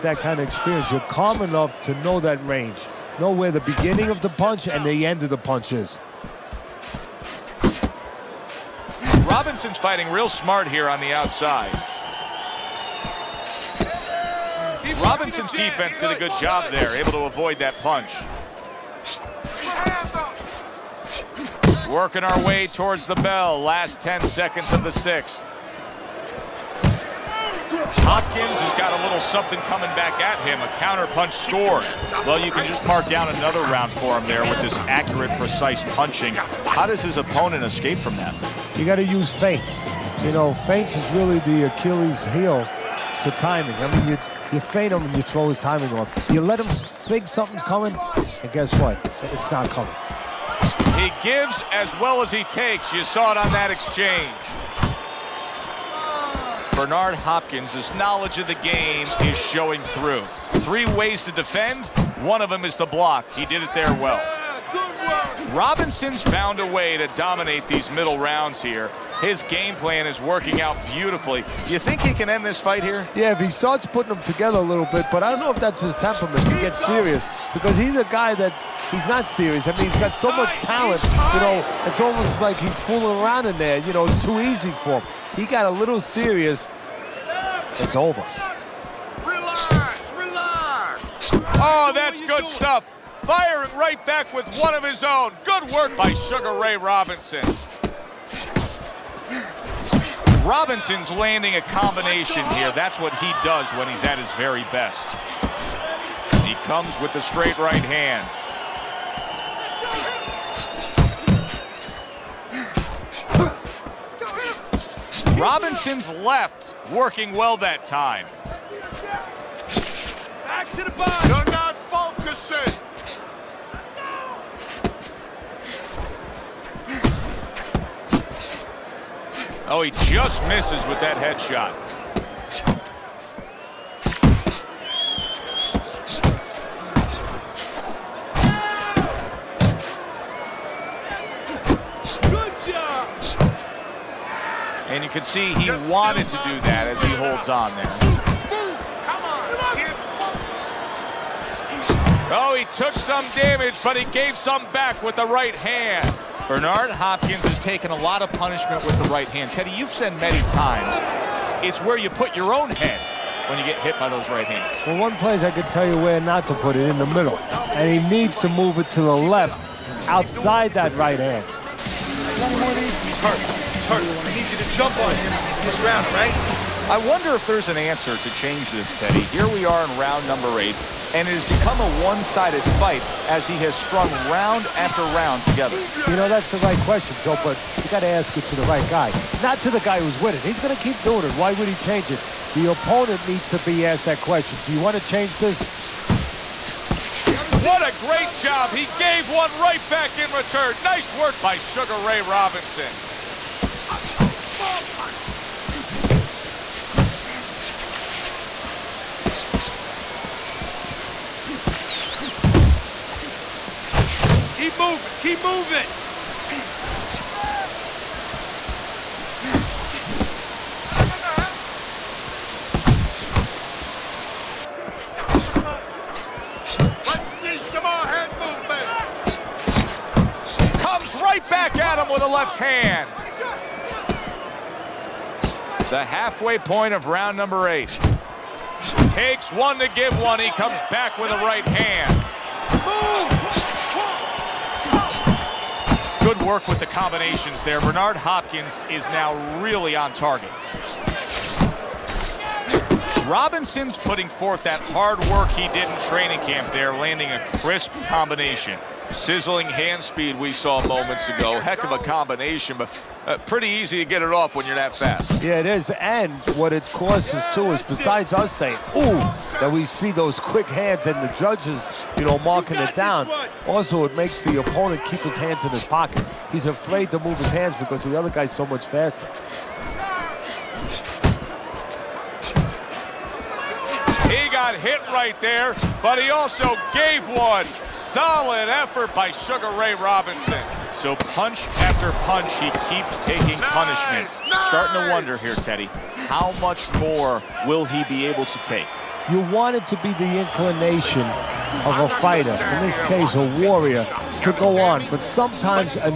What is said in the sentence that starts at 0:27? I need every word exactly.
Hopkins has got a little something coming back at him, a counter punch score.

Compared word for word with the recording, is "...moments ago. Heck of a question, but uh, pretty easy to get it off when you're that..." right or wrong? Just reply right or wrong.
wrong.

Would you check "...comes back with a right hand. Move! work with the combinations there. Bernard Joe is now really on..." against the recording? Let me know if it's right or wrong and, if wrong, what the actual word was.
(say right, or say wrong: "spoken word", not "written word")
wrong: "Hopkins", not "Joe".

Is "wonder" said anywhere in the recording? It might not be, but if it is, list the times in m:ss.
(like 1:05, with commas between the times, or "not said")
2:56, 4:55.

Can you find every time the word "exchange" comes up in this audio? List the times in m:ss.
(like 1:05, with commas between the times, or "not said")
0:53.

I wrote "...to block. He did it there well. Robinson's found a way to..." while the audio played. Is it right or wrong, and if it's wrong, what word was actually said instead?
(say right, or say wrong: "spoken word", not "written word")
right.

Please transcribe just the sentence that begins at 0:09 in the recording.
Robinson's fighting real smart here on the outside.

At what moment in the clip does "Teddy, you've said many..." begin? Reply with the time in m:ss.
2:39.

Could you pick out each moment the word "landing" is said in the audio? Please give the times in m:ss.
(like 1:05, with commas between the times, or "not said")
1:41, 4:16.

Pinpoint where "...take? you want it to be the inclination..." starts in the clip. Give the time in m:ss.
4:58.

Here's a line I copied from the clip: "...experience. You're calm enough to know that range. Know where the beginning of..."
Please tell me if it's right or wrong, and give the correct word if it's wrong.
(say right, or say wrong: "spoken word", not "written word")
right.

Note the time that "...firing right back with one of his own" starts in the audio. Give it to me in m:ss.
1:33.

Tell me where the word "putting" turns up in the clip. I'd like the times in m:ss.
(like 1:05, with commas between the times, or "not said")
1:13, 4:13.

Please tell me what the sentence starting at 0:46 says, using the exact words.
You let him think something's coming, and guess what?